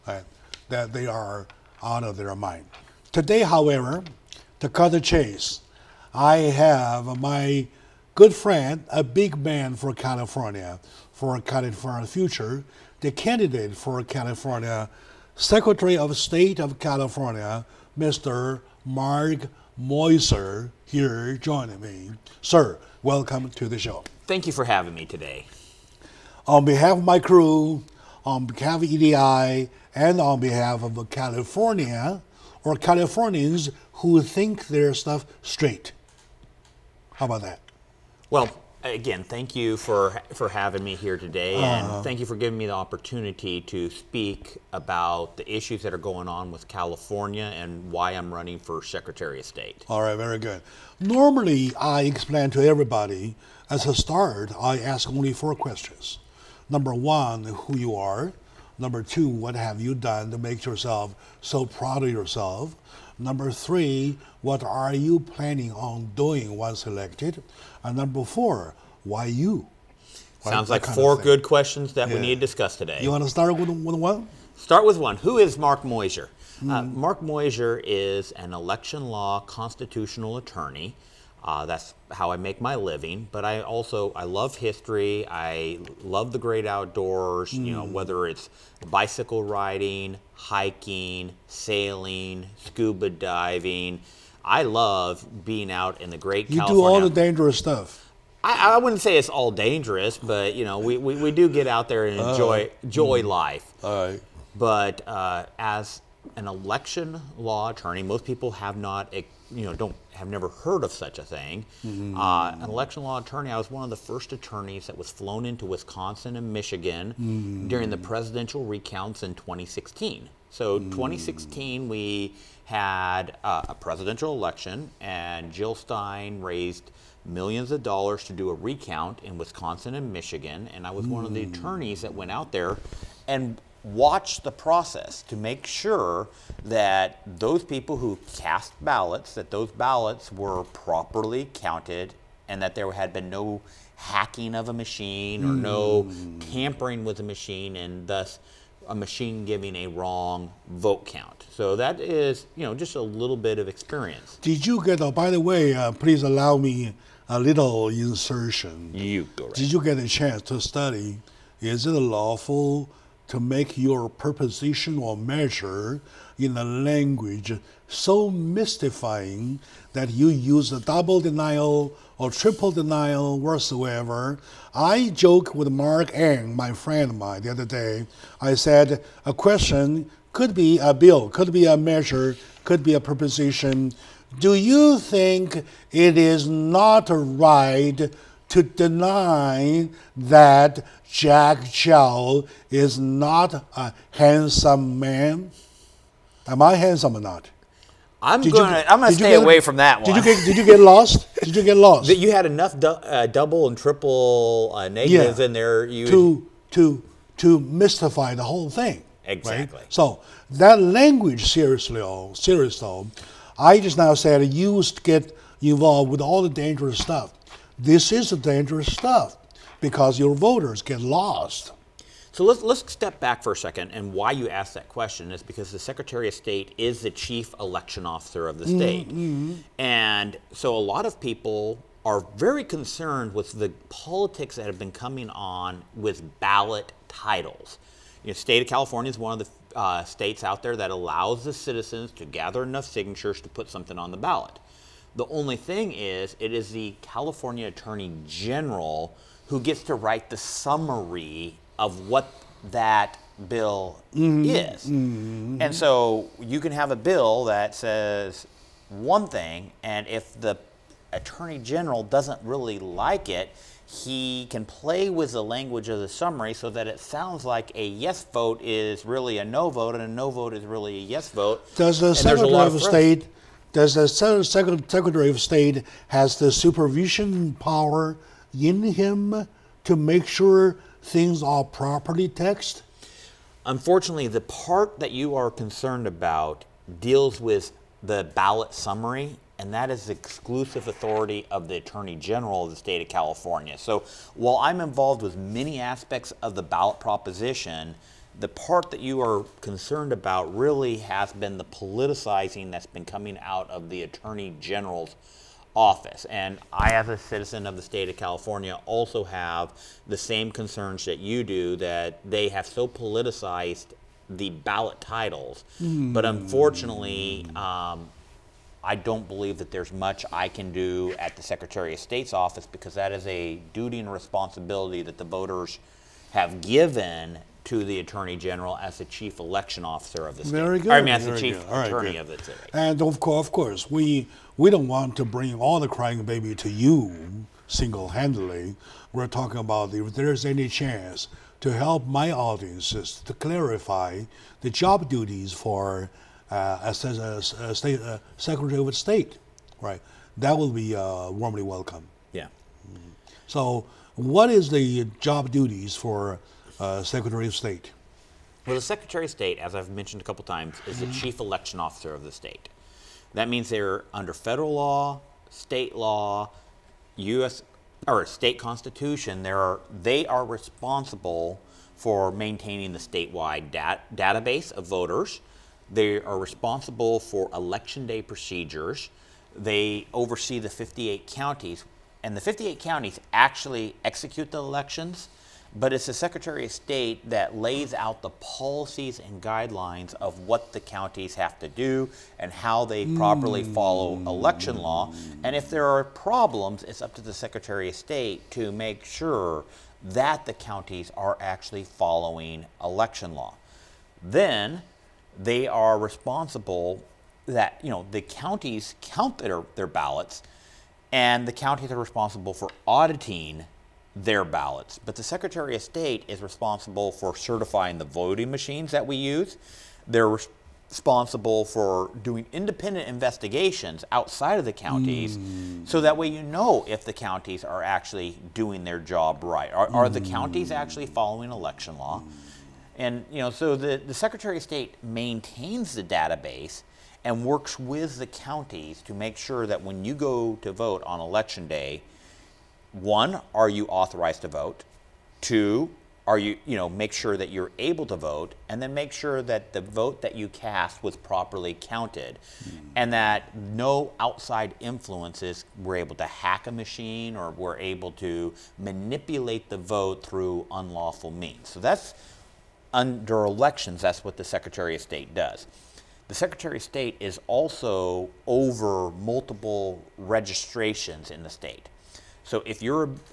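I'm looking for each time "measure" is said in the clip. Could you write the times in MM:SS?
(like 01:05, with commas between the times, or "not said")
02:45, 03:01.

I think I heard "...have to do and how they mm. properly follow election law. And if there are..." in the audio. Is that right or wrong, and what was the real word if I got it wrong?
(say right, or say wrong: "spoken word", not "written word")
right.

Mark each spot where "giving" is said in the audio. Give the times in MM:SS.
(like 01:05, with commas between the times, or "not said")
00:42, 02:29.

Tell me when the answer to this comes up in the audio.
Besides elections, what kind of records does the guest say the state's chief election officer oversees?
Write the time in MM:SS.
07:50.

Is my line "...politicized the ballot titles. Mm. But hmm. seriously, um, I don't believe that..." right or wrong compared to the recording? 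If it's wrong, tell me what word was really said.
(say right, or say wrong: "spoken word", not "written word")
wrong: "unfortunately", not "seriously".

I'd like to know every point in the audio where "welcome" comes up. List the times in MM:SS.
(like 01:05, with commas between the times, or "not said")
00:23, 05:51.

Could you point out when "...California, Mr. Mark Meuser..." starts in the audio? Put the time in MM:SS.
00:16.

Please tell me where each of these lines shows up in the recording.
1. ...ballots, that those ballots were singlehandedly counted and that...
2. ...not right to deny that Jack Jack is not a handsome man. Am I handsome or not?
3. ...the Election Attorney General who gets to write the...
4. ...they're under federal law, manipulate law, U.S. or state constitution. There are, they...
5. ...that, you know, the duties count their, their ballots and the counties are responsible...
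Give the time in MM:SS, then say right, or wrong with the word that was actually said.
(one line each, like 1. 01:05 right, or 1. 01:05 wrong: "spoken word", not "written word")
1. 02:18 wrong: "properly", not "singlehandedly"
2. 03:06 wrong: "Chow", not "Jack"
3. 04:06 wrong: "California", not "Election"
4. 06:03 wrong: "state", not "manipulate"
5. 06:47 wrong: "counties", not "duties".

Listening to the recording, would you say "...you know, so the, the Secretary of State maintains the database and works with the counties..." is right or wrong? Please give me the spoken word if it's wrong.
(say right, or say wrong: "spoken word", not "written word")
right.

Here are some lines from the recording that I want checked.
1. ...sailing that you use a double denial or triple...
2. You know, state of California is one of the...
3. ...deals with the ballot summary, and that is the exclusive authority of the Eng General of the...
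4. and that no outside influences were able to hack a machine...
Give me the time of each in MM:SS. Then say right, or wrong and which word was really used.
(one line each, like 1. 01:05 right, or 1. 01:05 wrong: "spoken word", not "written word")
1. 02:48 wrong: "mystifying", not "sailing"
2. 03:58 right
3. 04:47 wrong: "Attorney", not "Eng"
4. 07:32 right.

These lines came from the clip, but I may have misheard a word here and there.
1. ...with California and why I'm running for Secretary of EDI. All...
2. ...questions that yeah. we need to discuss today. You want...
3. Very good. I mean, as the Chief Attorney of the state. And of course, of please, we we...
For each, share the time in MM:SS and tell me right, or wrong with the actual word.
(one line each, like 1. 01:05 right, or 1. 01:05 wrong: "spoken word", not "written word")
1. 00:46 wrong: "State", not "EDI"
2. 01:11 right
3. 05:30 wrong: "course", not "please".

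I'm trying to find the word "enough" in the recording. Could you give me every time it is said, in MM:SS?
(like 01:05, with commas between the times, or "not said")
03:22, 04:02.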